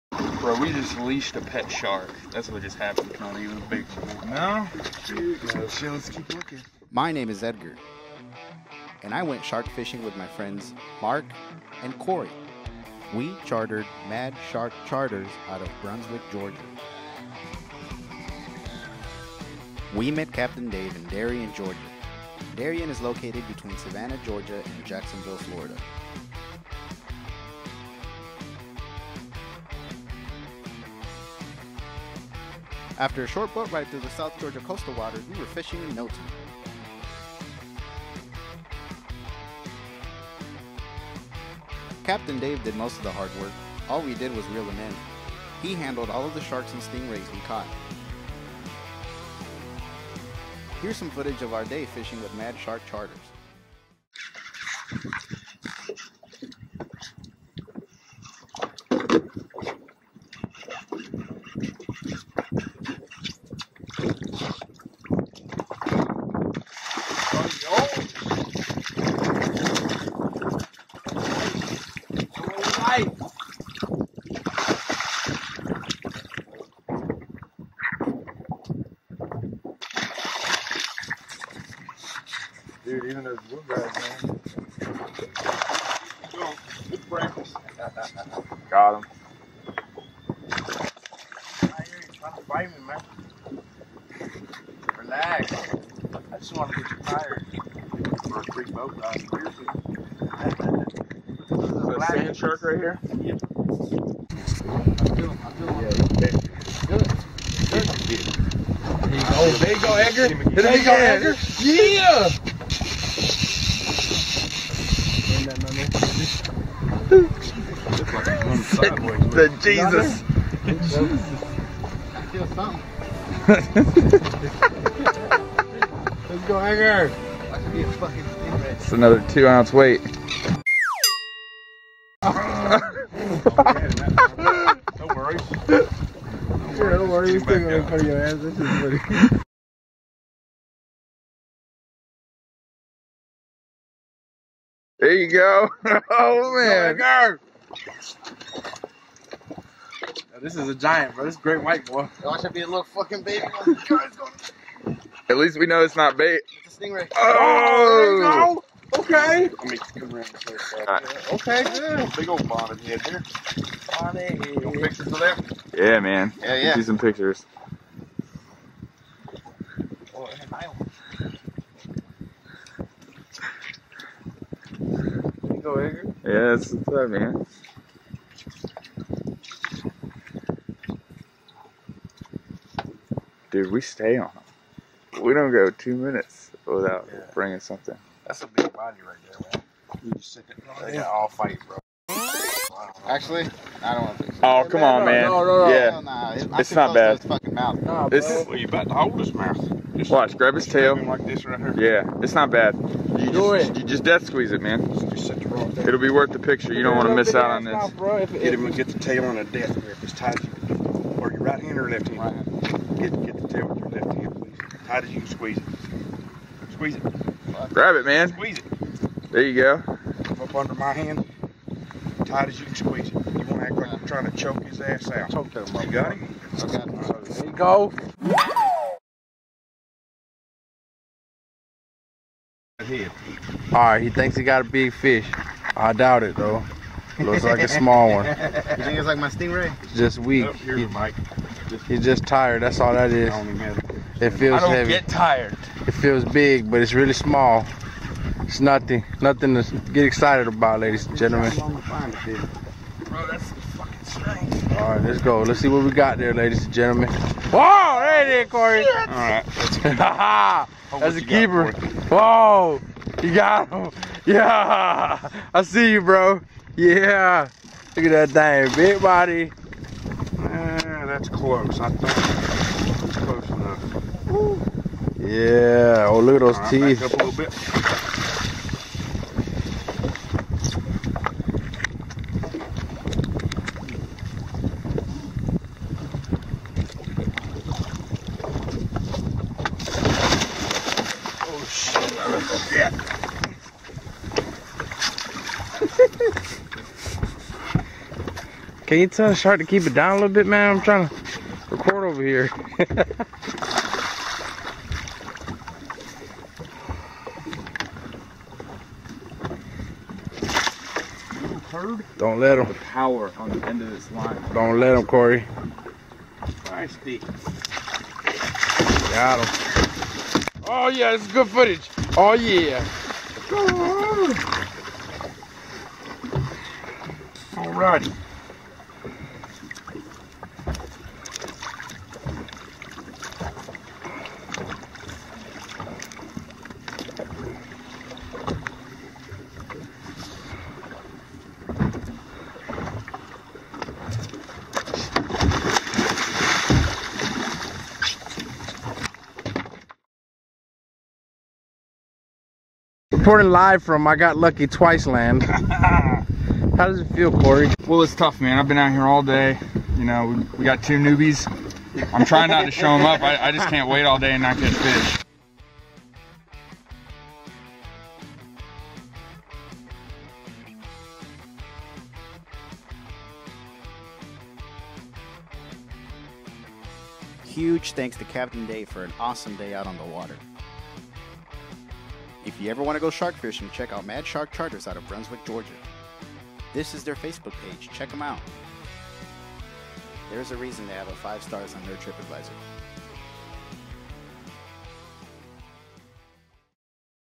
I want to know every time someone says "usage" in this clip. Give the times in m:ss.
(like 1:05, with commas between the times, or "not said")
not said.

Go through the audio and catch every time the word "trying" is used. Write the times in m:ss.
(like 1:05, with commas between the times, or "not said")
1:32, 3:44, 5:00, 6:02.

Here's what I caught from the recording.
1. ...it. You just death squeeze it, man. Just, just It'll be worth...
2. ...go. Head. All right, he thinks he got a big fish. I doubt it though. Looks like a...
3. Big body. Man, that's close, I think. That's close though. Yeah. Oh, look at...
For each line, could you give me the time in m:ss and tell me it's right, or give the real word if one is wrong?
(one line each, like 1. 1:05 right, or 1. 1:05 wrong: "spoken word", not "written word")
1. 3:23 right
2. 3:47 right
3. 4:28 wrong: "enough", not "though".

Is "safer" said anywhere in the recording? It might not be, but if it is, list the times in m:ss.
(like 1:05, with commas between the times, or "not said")
not said.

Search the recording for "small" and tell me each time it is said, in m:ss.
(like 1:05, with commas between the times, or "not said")
3:57, 4:07.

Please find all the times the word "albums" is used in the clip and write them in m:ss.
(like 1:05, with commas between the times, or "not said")
not said.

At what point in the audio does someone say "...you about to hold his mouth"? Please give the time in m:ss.
3:18.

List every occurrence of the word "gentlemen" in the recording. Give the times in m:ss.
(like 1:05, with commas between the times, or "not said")
4:11, 4:16.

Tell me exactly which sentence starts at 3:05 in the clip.
We don't go two minutes without yeah.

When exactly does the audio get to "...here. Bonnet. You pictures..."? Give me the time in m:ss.
2:43.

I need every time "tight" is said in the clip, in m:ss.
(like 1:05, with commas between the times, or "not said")
3:30, 3:34, 3:42.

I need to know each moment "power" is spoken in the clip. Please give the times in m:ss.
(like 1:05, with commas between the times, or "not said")
5:12.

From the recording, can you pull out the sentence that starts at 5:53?
Reporting live from I Got Lucky Twice Land.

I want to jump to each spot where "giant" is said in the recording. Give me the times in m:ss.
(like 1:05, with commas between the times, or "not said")
2:30.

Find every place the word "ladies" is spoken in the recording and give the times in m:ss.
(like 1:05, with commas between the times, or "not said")
4:10, 4:16.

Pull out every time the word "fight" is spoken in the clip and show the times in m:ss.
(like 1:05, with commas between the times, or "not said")
3:11.